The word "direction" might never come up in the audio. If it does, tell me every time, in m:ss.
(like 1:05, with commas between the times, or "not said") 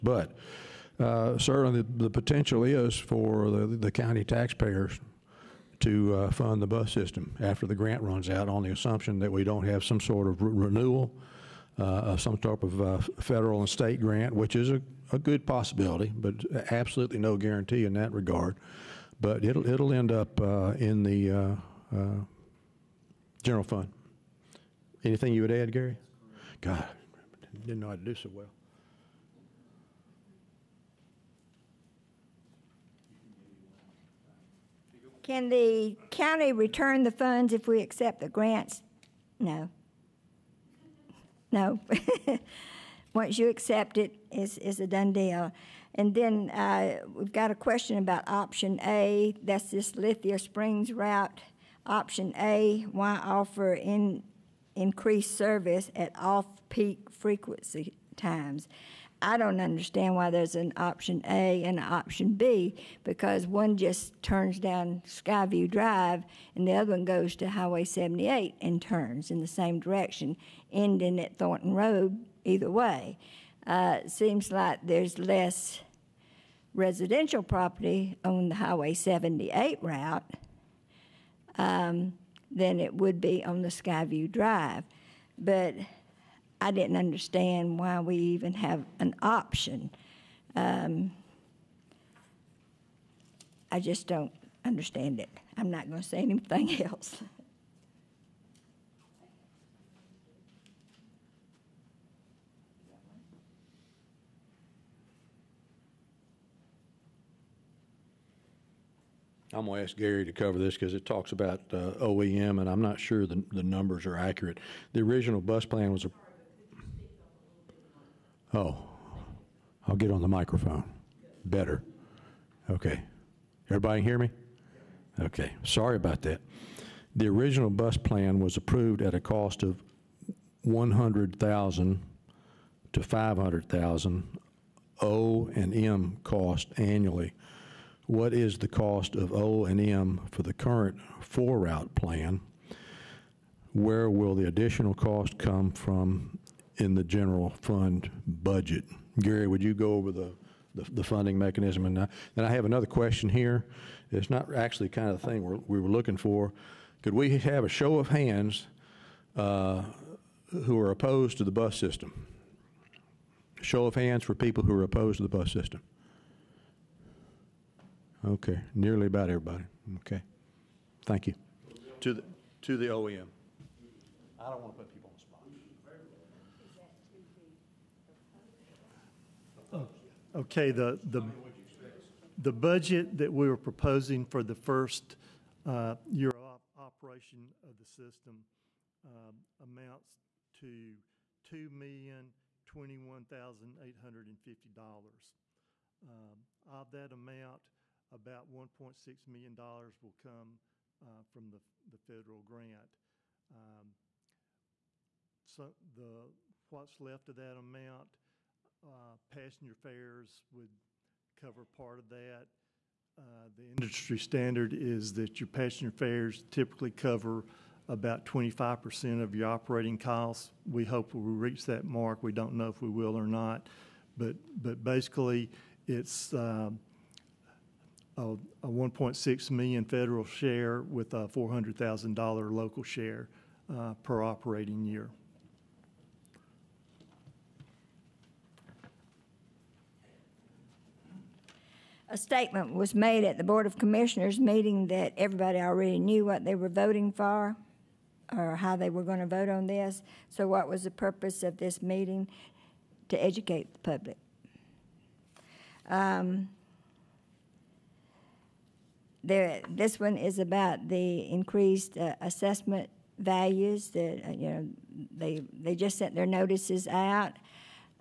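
1:09.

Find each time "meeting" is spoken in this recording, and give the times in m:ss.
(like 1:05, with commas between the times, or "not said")
4:04, 4:11.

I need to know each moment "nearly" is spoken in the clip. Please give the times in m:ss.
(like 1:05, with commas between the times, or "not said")
2:48.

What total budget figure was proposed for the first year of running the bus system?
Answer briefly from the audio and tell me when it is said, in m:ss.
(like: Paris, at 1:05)
$2,021,850, at 3:11.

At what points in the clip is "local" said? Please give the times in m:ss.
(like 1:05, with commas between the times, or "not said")
3:52.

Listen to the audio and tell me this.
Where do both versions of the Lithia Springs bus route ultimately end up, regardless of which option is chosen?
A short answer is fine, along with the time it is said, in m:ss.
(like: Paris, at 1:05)
Thornton Road, at 1:11.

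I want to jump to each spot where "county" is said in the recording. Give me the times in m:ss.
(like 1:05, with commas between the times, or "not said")
0:03, 0:36.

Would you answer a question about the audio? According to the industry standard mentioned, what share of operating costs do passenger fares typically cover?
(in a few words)
25%.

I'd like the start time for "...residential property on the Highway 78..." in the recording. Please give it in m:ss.
1:16.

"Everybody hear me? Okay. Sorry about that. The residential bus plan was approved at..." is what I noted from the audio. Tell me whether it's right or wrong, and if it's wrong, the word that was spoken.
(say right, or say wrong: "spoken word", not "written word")
wrong: "original", not "residential".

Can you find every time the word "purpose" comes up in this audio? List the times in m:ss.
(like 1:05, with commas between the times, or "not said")
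4:10.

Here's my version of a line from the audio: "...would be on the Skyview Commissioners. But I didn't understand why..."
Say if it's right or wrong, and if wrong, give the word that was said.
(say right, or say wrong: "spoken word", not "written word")
wrong: "Drive", not "Commissioners".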